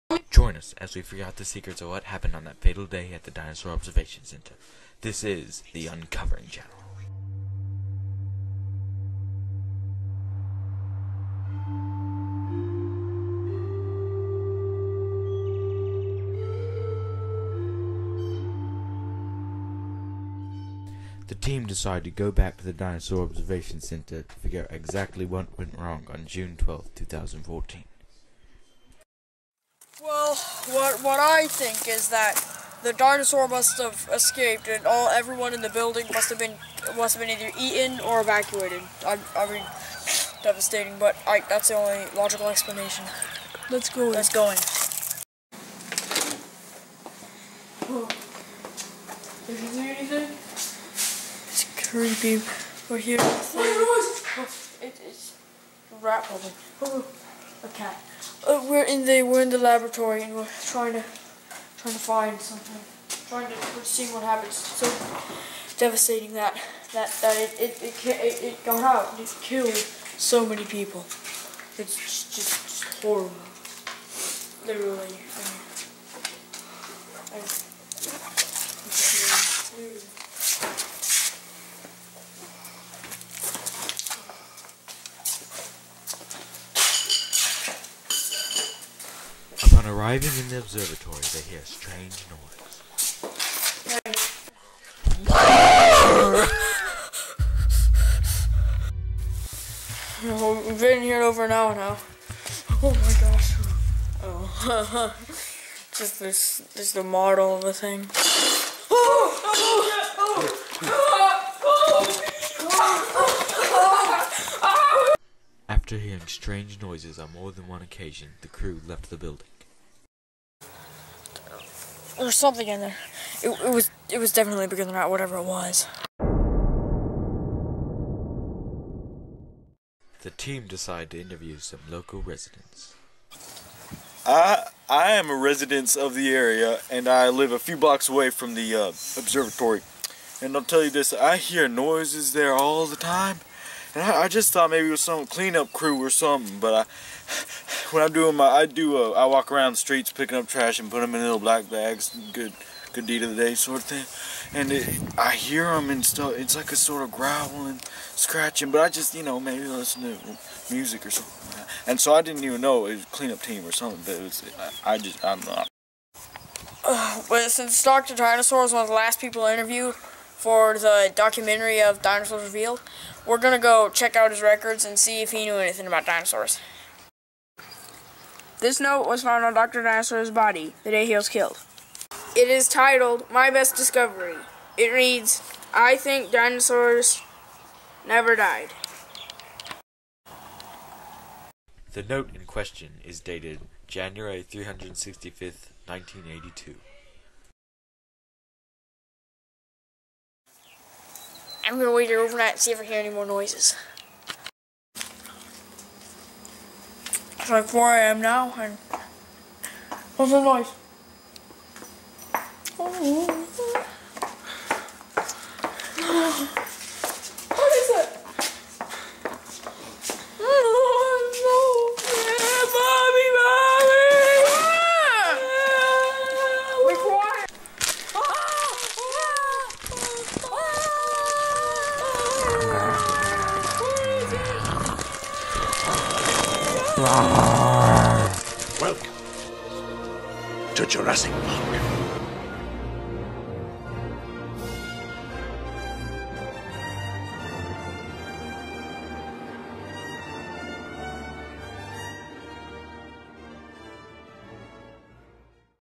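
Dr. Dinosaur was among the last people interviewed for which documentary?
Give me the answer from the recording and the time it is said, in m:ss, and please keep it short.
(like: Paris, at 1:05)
Dinosaurs Revealed, at 2:52.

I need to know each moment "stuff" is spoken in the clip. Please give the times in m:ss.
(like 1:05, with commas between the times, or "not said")
2:36.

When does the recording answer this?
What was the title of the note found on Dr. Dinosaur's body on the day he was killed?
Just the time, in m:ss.
3:03.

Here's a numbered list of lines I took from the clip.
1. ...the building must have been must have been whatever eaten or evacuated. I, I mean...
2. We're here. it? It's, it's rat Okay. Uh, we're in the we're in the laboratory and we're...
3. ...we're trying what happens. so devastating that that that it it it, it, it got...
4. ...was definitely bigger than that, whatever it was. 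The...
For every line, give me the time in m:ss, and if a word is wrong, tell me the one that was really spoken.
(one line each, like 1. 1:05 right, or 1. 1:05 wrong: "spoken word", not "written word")
1. 0:35 wrong: "either", not "whatever"
2. 0:52 right
3. 1:03 wrong: "seeing", not "trying"
4. 2:04 right.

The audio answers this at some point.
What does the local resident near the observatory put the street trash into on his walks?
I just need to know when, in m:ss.
2:31.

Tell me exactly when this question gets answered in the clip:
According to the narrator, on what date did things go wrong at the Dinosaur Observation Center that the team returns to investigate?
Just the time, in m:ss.
0:26.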